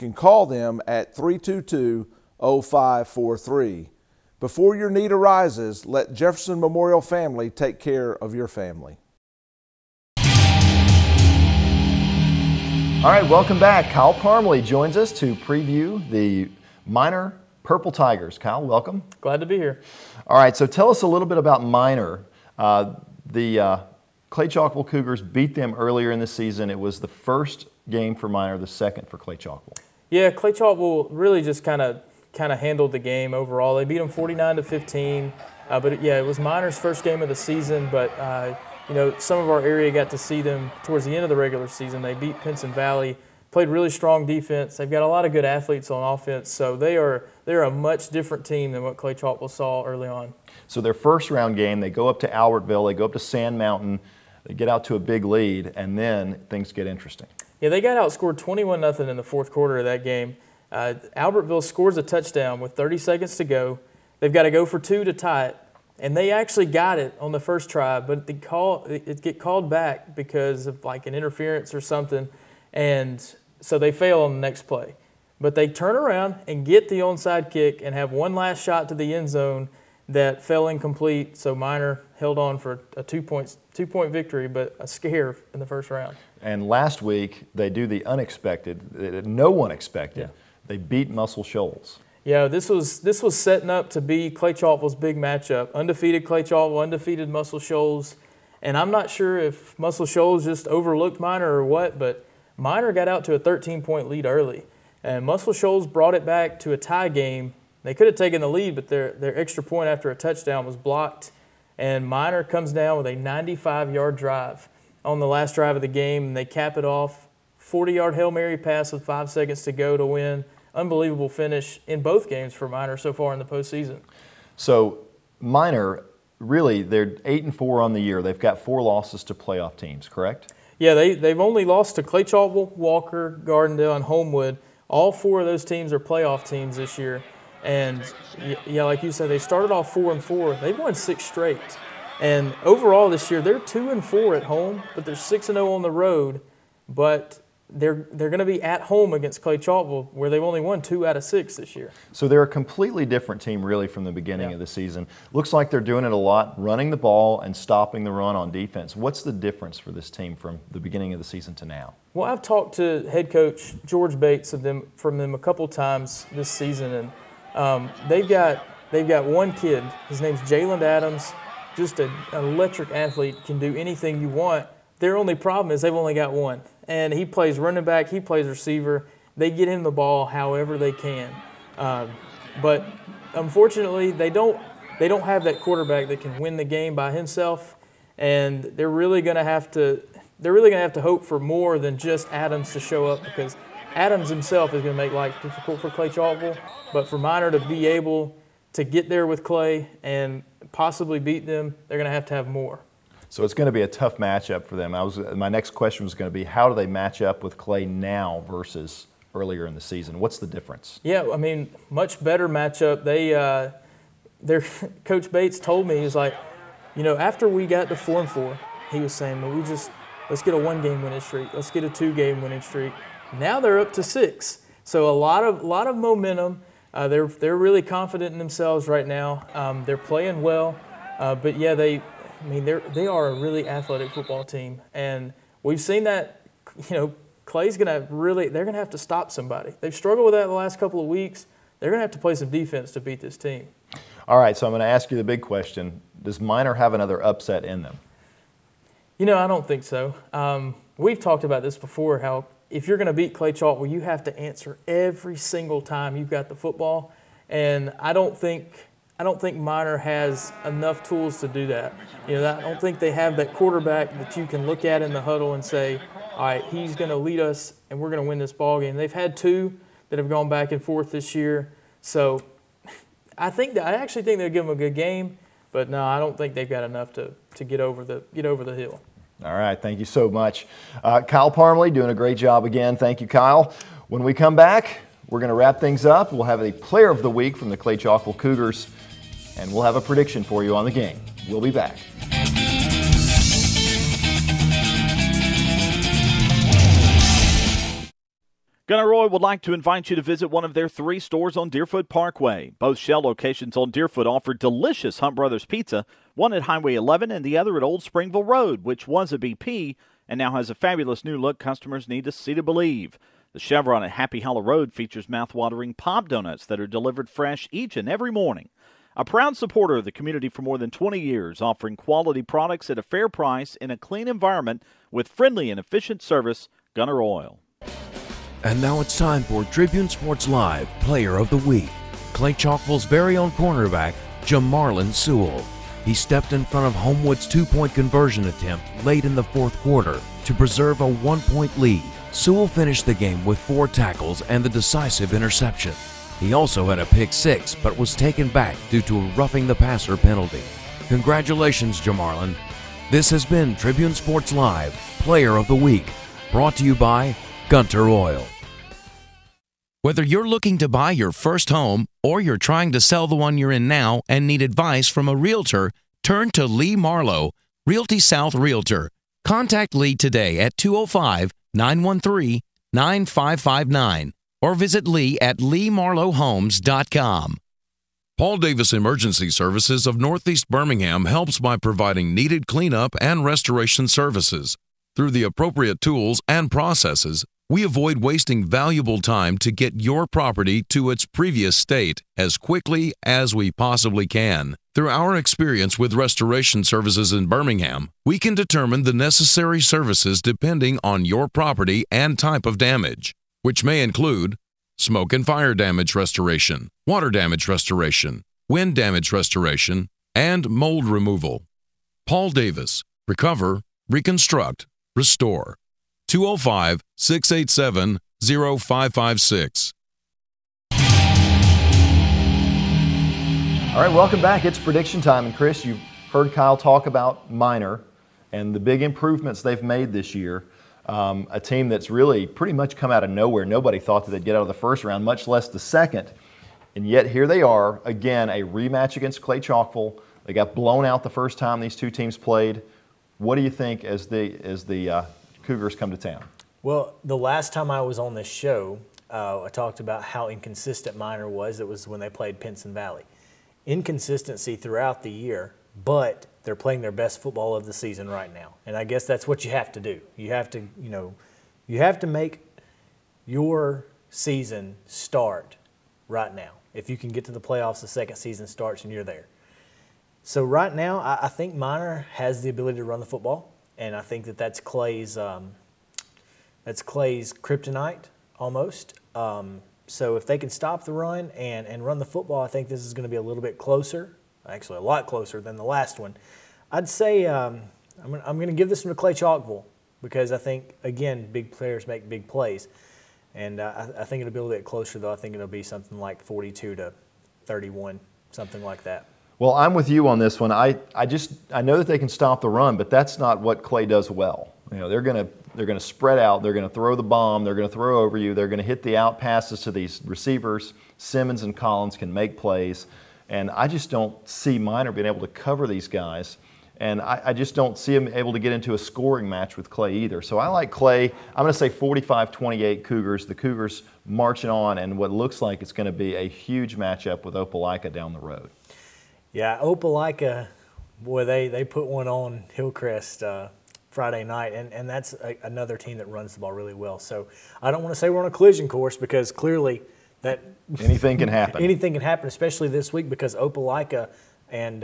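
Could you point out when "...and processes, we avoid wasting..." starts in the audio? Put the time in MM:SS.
06:26.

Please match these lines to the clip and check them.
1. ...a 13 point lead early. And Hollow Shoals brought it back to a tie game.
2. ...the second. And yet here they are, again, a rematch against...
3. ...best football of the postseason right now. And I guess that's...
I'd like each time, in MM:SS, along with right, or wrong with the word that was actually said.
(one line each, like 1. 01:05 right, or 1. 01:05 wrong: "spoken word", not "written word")
1. 01:43 wrong: "Muscle", not "Hollow"
2. 07:15 right
3. 07:37 wrong: "season", not "postseason".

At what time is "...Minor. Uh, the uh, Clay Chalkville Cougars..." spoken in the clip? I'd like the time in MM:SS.
00:21.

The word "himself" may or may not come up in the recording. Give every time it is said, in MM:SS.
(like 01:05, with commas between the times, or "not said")
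03:07, 03:14.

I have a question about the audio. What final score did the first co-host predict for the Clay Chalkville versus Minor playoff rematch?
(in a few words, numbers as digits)
42-31.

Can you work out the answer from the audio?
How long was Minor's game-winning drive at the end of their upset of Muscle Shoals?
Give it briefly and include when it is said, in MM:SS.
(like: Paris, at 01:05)
95 yards, at 01:53.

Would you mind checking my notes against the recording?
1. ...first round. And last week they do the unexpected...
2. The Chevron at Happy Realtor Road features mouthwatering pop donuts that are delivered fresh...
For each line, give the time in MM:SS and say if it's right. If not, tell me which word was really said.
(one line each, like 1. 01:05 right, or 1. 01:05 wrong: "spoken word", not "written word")
1. 01:25 right
2. 05:13 wrong: "Hollow", not "Realtor".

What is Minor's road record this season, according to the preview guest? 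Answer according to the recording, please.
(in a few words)
6-0.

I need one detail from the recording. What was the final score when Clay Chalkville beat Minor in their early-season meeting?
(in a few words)
49-15.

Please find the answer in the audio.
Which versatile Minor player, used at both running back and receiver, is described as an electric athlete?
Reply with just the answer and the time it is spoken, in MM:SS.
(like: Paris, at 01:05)
Jalen Adams, at 02:50.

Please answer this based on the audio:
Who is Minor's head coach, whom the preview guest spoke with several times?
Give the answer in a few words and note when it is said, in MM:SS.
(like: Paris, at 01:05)
George Bates, at 02:43.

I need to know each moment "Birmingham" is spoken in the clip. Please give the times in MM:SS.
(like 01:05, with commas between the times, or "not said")
06:20, 06:37.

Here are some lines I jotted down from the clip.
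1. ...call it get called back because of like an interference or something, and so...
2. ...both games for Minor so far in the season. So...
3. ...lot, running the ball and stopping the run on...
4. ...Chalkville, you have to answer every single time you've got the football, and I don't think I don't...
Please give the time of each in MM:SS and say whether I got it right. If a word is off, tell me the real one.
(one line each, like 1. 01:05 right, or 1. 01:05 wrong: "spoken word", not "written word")
1. 01:08 right
2. 02:02 wrong: "postseason", not "season"
3. 02:36 right
4. 04:13 right.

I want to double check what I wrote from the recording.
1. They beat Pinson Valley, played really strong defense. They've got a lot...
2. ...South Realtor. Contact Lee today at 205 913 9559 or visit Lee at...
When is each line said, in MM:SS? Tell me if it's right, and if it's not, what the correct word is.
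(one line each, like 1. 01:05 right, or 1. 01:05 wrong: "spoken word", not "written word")
1. 00:42 right
2. 06:08 right.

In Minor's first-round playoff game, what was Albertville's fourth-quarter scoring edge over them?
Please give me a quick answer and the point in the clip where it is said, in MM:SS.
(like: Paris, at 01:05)
21-0, at 00:58.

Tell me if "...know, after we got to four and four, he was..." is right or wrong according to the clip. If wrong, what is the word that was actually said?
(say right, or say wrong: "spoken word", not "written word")
right.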